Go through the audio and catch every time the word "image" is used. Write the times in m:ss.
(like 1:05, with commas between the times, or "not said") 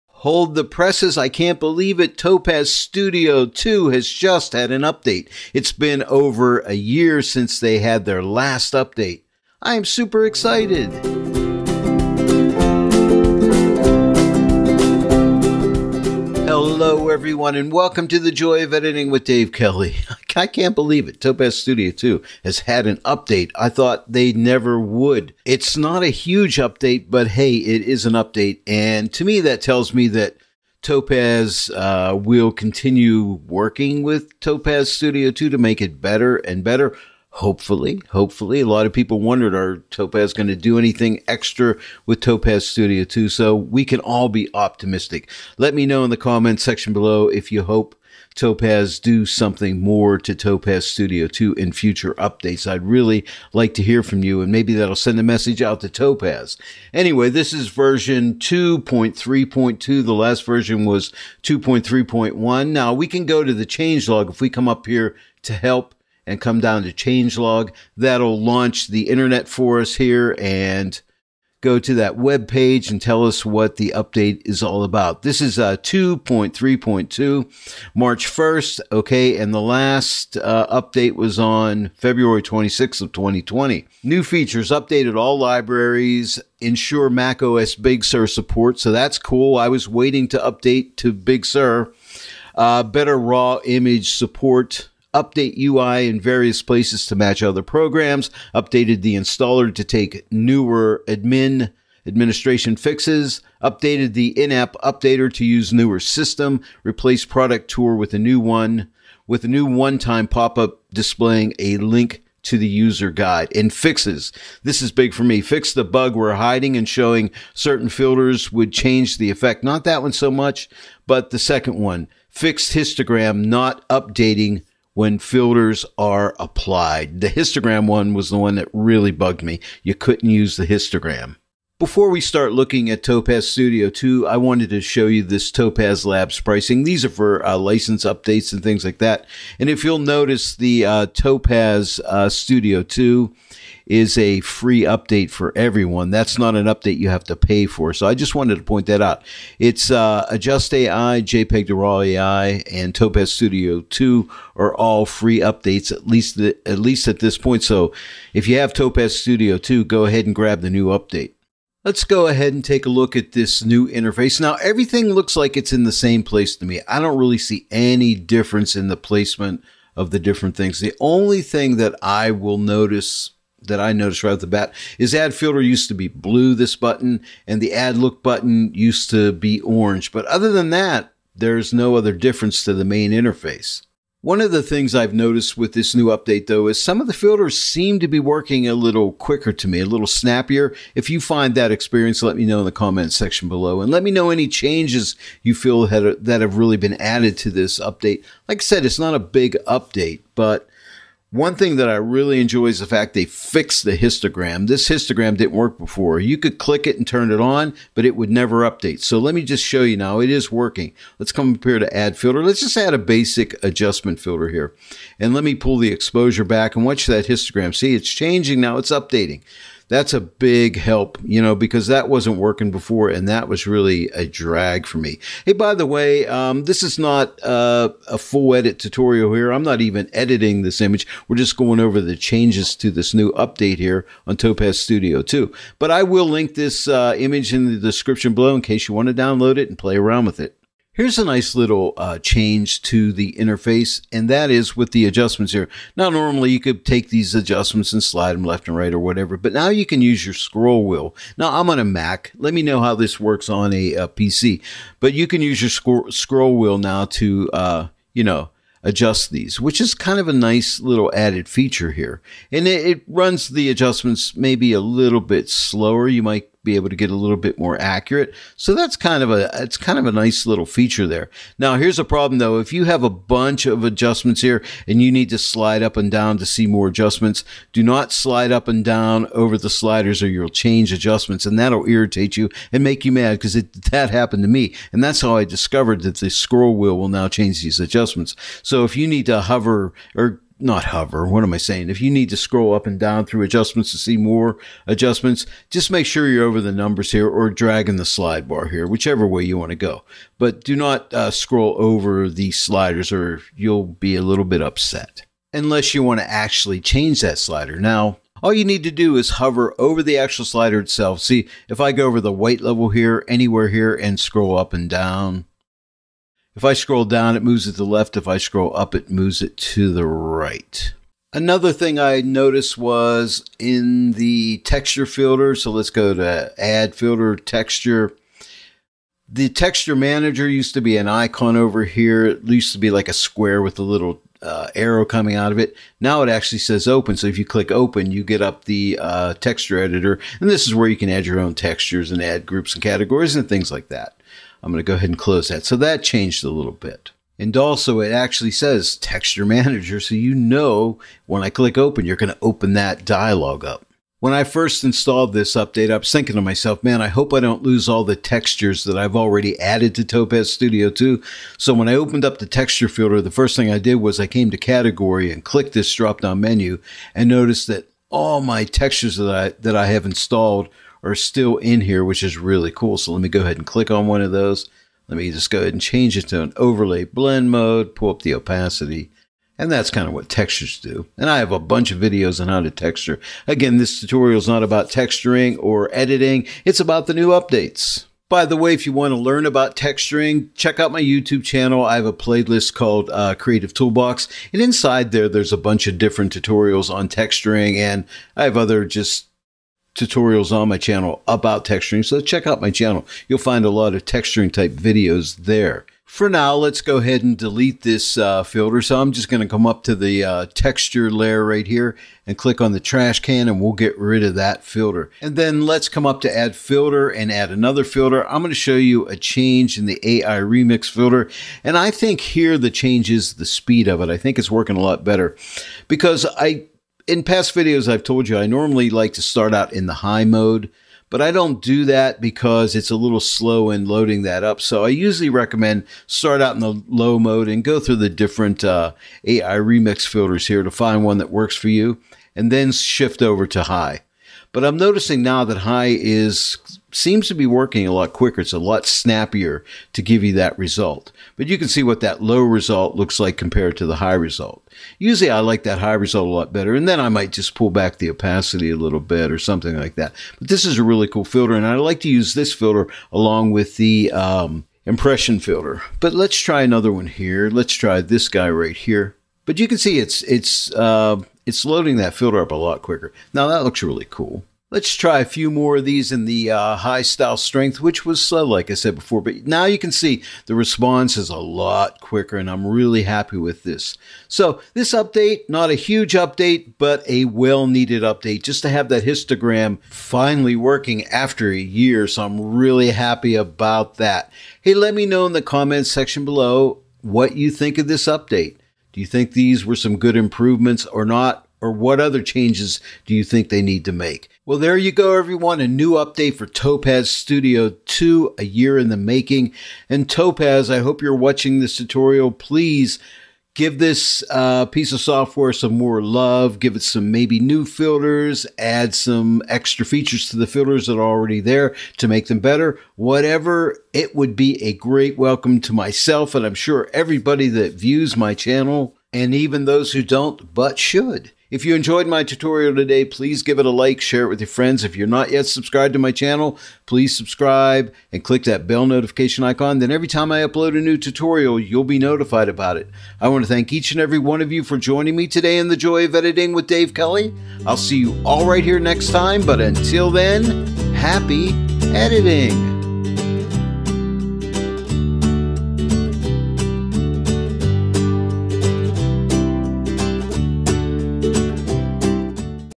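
1:33, 3:50, 3:57.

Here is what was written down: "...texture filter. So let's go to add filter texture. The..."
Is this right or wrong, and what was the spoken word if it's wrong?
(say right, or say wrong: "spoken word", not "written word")
right.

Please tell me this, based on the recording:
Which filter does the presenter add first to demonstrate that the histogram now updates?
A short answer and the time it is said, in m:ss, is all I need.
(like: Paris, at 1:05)
Basic adjustment, at 3:32.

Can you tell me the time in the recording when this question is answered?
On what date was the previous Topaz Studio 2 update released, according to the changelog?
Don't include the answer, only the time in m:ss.
1:21.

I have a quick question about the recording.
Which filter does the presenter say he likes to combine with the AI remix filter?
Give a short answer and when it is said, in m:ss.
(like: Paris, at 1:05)
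Impression, at 7:44.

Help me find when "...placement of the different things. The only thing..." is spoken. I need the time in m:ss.
2:48.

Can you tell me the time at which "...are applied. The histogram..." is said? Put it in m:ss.
2:05.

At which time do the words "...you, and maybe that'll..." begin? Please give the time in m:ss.
0:54.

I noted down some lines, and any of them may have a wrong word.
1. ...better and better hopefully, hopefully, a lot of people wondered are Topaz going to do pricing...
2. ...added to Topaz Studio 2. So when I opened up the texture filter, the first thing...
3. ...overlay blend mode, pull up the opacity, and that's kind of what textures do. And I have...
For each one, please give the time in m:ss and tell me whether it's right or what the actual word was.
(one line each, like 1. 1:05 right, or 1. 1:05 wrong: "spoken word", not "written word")
1. 0:35 wrong: "anything", not "pricing"
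2. 5:59 right
3. 6:16 right.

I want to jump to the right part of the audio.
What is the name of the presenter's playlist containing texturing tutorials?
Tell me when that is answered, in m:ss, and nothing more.
6:33.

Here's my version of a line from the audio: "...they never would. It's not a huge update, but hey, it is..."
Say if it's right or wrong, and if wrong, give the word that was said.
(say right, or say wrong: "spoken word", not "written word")
right.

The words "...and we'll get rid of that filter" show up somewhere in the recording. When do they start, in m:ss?
6:53.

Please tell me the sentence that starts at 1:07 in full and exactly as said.
That'll launch the internet for us here and go to that web page and tell us what the update is all about.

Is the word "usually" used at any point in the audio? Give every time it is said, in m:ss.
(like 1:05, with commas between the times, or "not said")
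7:14, 7:34.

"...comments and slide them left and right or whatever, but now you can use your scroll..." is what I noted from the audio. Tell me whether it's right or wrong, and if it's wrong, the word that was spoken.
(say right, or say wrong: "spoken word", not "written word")
wrong: "adjustments", not "comments".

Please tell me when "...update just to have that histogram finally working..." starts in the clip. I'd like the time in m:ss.
8:08.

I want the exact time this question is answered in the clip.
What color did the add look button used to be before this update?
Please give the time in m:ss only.
2:59.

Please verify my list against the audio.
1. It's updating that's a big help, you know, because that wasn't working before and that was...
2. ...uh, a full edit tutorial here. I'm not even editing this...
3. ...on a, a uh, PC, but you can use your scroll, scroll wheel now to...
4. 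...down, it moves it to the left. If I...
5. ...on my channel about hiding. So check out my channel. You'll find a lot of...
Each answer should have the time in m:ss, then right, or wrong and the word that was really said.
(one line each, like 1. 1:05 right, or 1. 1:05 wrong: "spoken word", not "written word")
1. 3:38 right
2. 3:47 right
3. 4:13 right
4. 5:17 right
5. 6:40 wrong: "texturing", not "hiding".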